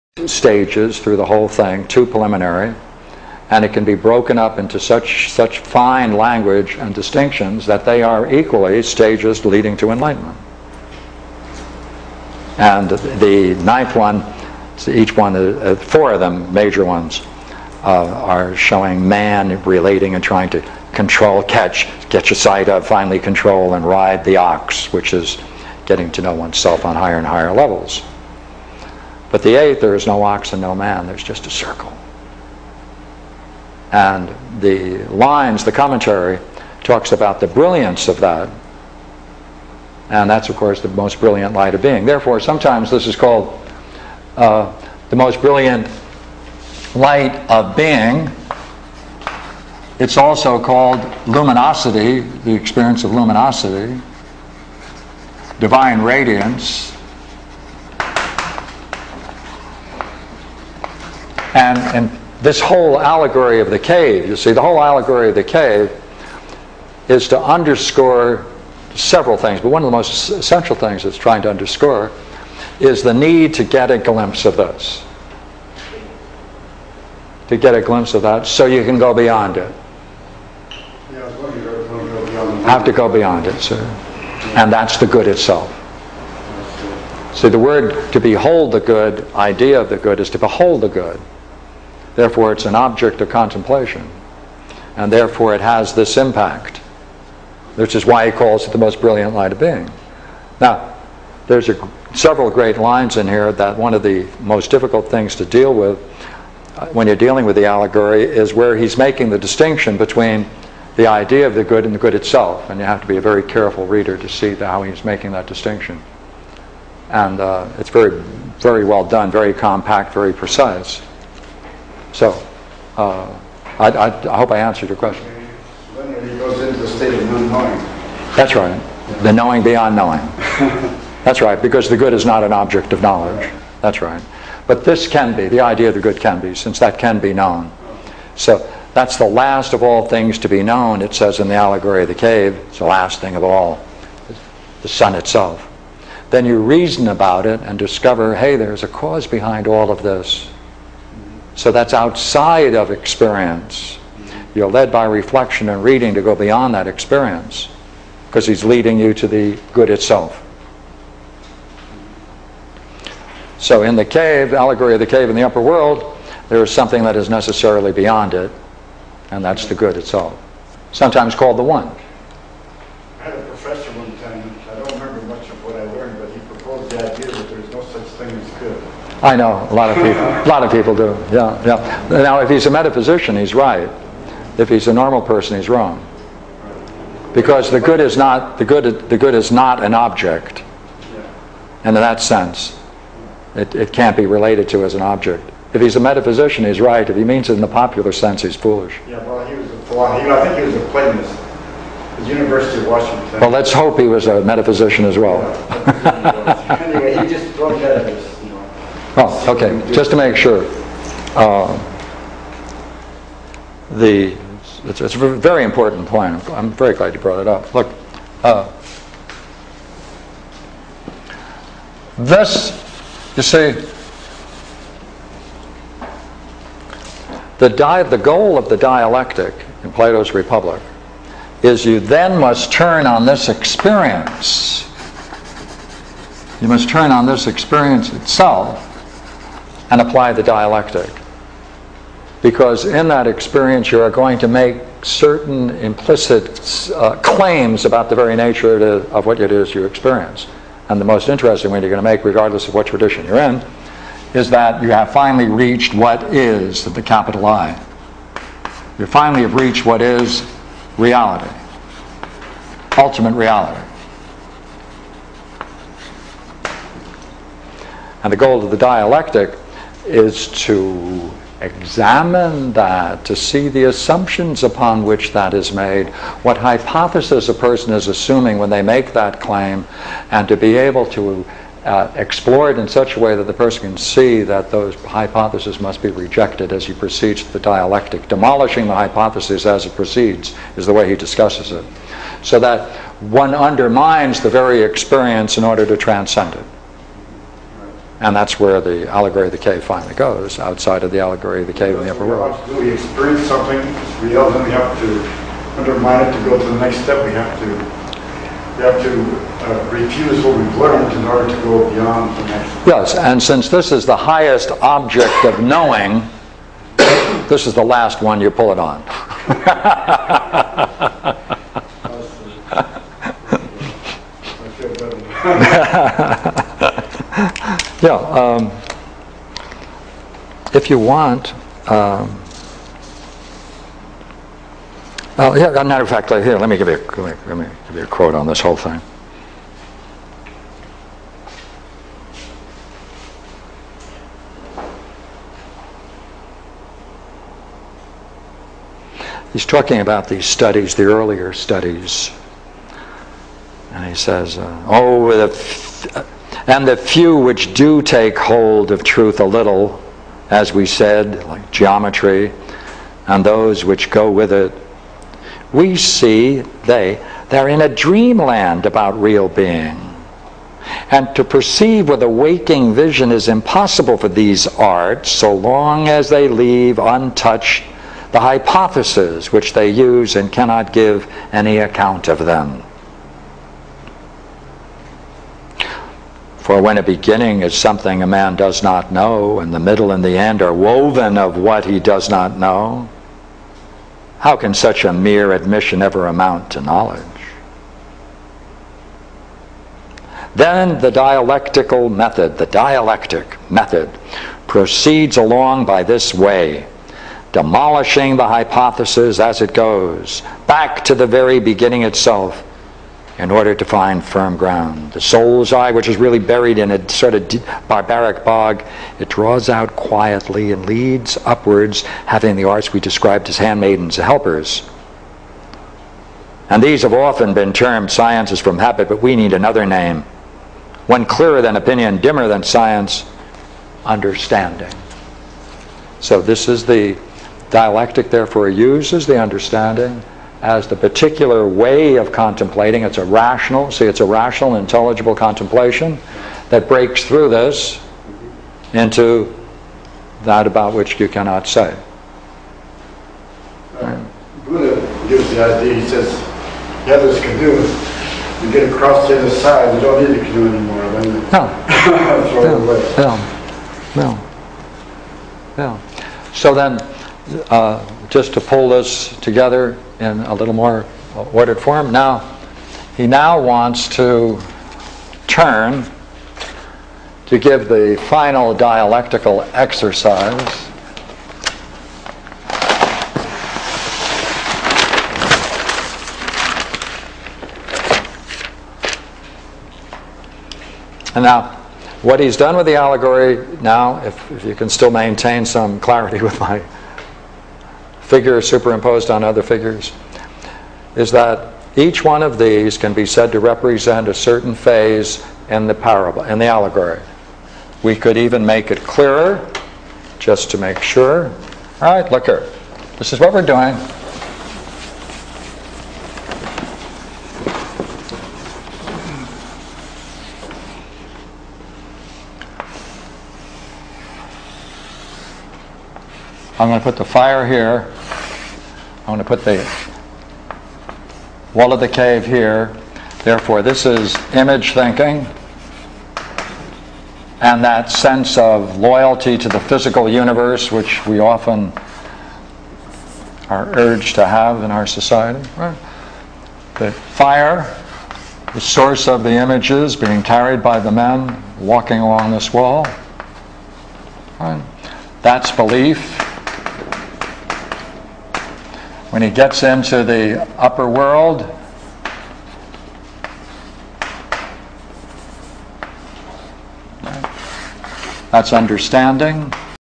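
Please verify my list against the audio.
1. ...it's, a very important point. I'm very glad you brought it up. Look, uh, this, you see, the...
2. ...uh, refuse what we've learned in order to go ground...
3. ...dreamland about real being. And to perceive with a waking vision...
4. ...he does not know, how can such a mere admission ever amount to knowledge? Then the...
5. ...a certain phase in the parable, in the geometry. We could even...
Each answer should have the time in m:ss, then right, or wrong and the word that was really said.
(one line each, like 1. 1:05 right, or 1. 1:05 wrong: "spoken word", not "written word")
1. 3:35 right
2. 5:09 wrong: "beyond", not "ground"
3. 6:07 right
4. 6:31 right
5. 8:24 wrong: "allegory", not "geometry".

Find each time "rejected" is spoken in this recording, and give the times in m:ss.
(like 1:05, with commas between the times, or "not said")
4:46.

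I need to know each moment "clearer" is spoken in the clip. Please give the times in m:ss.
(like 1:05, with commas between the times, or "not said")
7:11, 8:29.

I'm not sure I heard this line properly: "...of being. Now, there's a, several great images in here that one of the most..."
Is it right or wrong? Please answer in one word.
wrong.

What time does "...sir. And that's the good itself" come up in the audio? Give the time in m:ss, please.
1:23.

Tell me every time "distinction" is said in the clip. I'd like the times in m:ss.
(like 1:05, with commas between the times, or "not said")
0:06, 1:49, 1:55.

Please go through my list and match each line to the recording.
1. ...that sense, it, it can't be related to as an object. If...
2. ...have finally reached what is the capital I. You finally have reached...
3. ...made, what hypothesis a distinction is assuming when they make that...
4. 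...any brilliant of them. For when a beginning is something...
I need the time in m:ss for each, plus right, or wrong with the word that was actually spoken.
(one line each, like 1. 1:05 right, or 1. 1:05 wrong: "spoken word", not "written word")
1. 3:12 right
2. 4:14 right
3. 4:35 wrong: "person", not "distinction"
4. 6:21 wrong: "account", not "brilliant".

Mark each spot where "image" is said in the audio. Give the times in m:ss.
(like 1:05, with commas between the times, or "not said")
8:54, 9:09.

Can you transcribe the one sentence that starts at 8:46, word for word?
I'm going to put the fire here.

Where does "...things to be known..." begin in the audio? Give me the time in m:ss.
2:20.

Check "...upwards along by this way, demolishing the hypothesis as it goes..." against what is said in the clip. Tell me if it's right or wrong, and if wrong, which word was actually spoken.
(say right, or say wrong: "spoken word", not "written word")
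wrong: "proceeds", not "upwards".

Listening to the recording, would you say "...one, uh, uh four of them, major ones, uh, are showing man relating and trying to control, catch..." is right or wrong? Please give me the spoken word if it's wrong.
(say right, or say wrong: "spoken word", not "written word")
right.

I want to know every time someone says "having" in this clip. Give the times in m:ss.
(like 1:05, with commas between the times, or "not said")
7:02.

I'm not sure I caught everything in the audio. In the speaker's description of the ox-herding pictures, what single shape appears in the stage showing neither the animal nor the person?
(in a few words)
A circle.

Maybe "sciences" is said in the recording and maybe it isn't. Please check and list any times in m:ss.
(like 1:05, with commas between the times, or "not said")
7:08, 7:12.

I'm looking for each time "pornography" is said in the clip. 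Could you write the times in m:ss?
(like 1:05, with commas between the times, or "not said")
not said.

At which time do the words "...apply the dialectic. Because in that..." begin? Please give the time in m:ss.
3:59.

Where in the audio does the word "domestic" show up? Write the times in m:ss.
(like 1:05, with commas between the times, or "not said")
not said.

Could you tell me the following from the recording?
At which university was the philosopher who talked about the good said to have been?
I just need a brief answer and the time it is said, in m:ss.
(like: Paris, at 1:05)
University of Washington, at 3:22.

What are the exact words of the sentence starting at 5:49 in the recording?
he's talking about these studies, the earlier studies.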